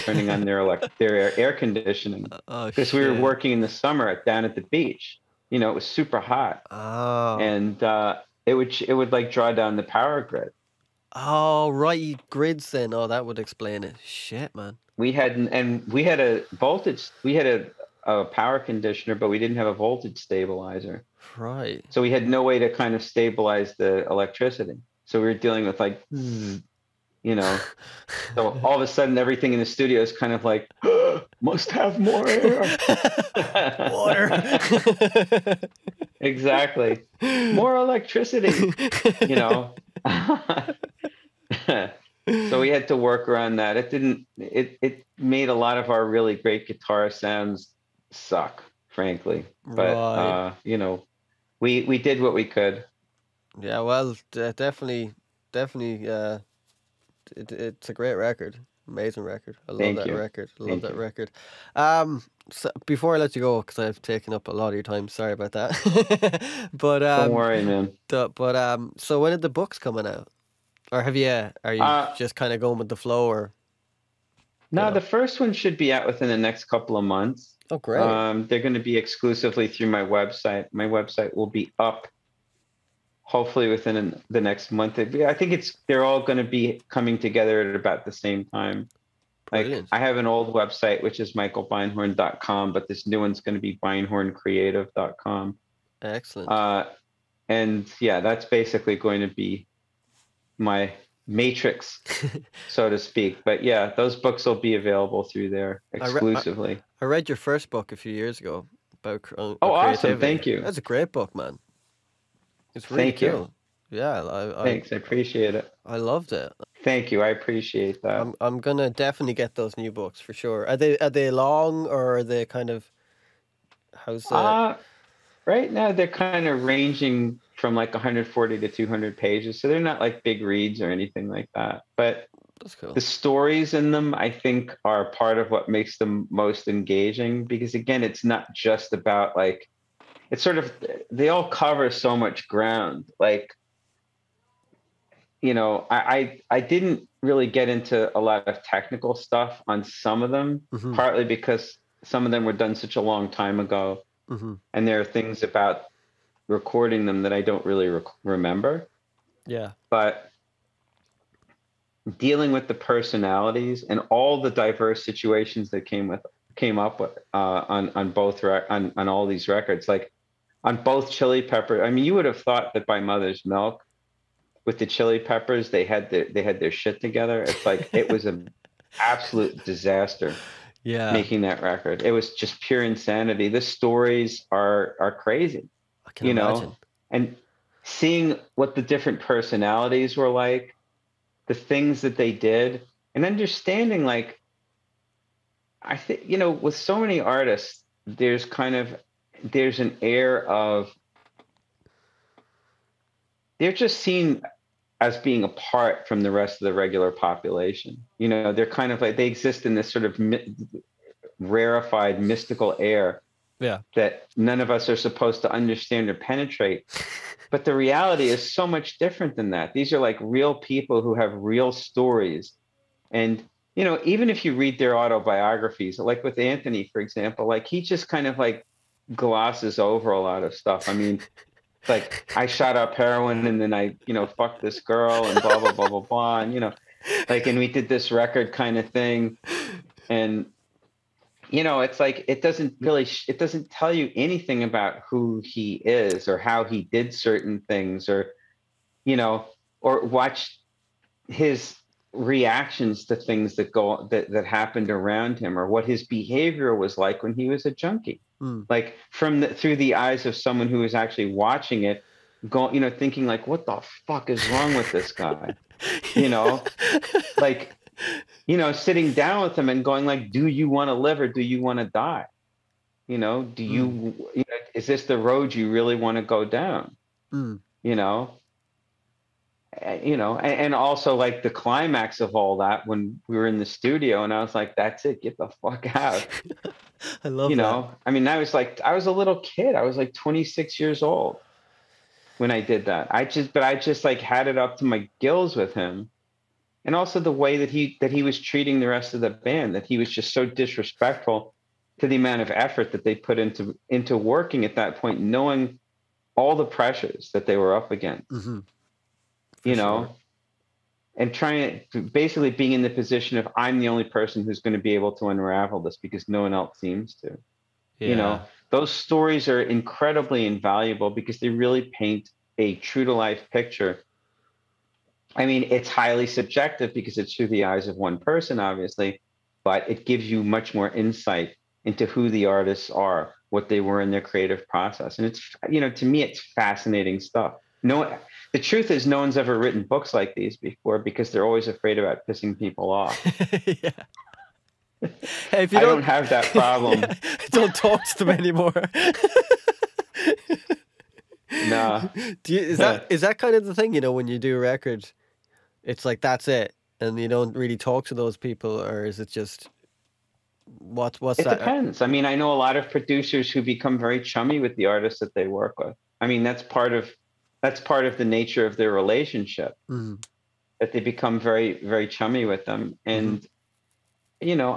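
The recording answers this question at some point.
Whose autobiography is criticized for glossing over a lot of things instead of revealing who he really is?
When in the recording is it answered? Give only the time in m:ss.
3:46.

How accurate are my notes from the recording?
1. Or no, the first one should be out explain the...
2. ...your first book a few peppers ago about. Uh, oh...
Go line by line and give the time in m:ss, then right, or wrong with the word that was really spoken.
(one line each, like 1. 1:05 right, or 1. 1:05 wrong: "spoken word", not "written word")
1. 1:13 wrong: "within", not "explain"
2. 1:47 wrong: "years", not "peppers".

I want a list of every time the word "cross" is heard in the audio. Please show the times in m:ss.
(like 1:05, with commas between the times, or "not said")
not said.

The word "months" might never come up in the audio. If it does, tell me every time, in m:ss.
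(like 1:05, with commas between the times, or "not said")
1:17, 1:24.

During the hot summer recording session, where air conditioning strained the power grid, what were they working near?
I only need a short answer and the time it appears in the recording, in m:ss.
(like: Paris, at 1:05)
the beach, at 0:04.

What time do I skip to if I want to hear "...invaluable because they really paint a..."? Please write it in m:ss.
5:20.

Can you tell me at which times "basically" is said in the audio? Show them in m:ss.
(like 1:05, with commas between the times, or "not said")
1:38, 5:12.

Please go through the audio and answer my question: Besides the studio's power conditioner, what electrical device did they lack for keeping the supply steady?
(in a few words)
voltage stabilizer.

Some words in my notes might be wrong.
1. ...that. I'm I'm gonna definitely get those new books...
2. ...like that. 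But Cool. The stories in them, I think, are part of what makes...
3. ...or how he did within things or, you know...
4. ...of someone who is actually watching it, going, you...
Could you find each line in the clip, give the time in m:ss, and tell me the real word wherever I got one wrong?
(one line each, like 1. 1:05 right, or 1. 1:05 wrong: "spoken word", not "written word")
1. 1:58 right
2. 2:11 right
3. 4:06 wrong: "certain", not "within"
4. 4:20 right.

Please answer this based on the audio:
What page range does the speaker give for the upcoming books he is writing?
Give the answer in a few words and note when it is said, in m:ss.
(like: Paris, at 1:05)
140 to 200 pages, at 2:07.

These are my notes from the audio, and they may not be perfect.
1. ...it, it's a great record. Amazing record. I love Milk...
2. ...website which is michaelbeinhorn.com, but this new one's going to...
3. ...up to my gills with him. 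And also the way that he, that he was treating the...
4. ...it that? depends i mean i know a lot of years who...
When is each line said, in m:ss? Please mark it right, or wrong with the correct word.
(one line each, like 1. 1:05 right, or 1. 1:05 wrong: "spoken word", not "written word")
1. 0:57 wrong: "Thank", not "Milk"
2. 1:30 right
3. 4:54 right
4. 6:01 wrong: "producers", not "years".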